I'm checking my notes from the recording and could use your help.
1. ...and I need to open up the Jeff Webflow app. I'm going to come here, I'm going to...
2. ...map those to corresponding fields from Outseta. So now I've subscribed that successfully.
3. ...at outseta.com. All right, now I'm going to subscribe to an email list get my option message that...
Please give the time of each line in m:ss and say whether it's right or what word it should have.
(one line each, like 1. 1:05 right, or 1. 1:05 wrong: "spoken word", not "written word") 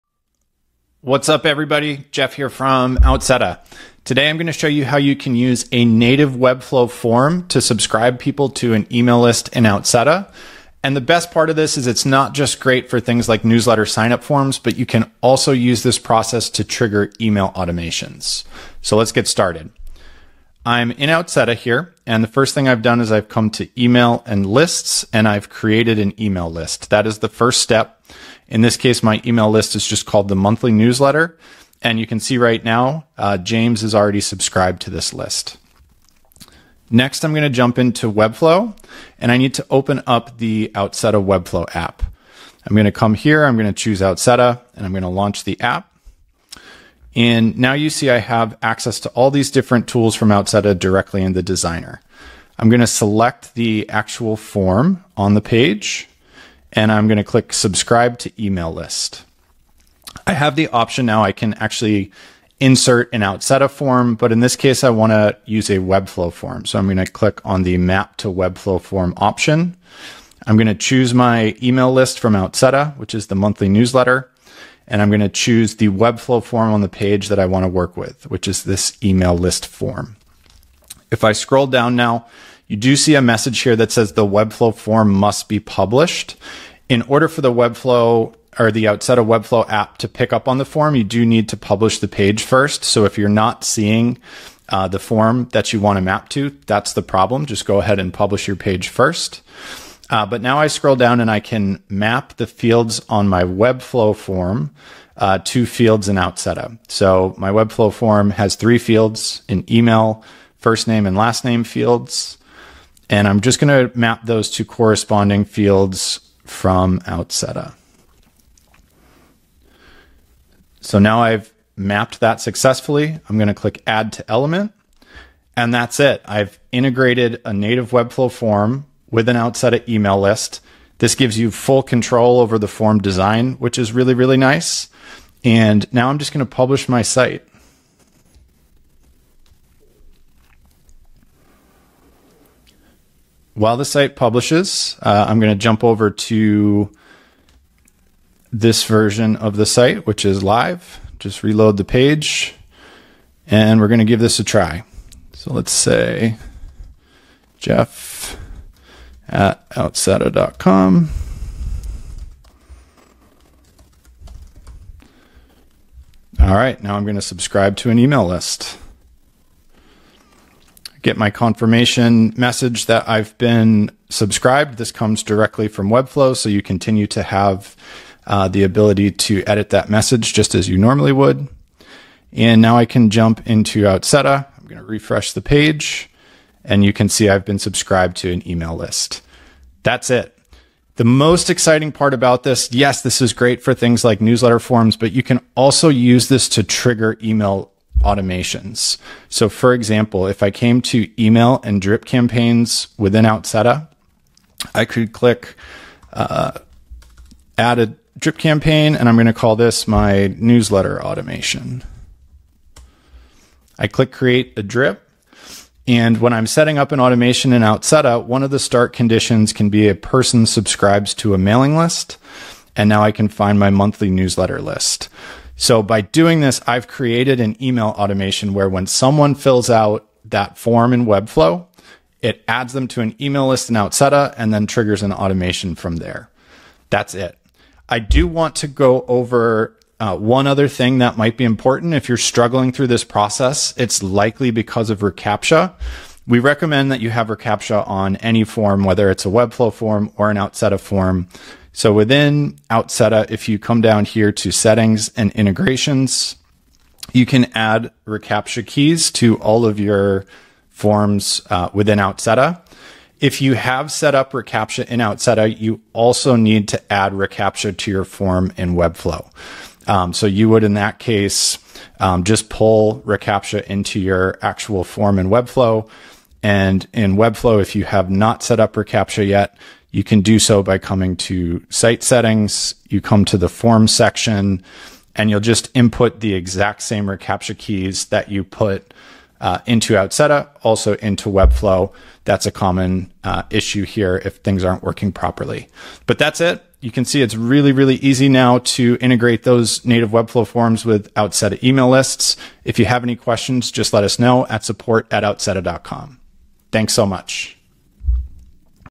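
1. 0:39 wrong: "Outseta", not "Jeff"
2. 1:53 wrong: "mapped", not "subscribed"
3. 2:39 wrong: "confirmation", not "option".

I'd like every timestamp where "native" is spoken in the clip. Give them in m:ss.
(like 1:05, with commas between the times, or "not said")
0:05, 2:07, 4:59.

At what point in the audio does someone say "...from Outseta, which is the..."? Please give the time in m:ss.
1:12.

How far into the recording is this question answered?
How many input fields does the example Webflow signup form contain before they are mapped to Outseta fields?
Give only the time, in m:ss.
1:48.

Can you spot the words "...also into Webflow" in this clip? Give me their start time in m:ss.
4:50.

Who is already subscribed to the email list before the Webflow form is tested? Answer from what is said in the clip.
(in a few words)
James.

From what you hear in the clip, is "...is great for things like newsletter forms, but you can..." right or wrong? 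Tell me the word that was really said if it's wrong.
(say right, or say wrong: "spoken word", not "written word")
right.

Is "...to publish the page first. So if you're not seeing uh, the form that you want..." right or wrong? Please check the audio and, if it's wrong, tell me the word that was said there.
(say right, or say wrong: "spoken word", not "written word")
right.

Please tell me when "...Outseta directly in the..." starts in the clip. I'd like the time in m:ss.
0:50.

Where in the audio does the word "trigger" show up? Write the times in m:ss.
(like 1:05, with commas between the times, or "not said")
0:16, 3:16, 3:54.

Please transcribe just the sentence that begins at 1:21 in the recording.
If I scroll down now, you do see a message here that says the Webflow form must be published.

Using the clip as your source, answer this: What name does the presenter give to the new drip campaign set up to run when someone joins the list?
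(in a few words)
newsletter automation.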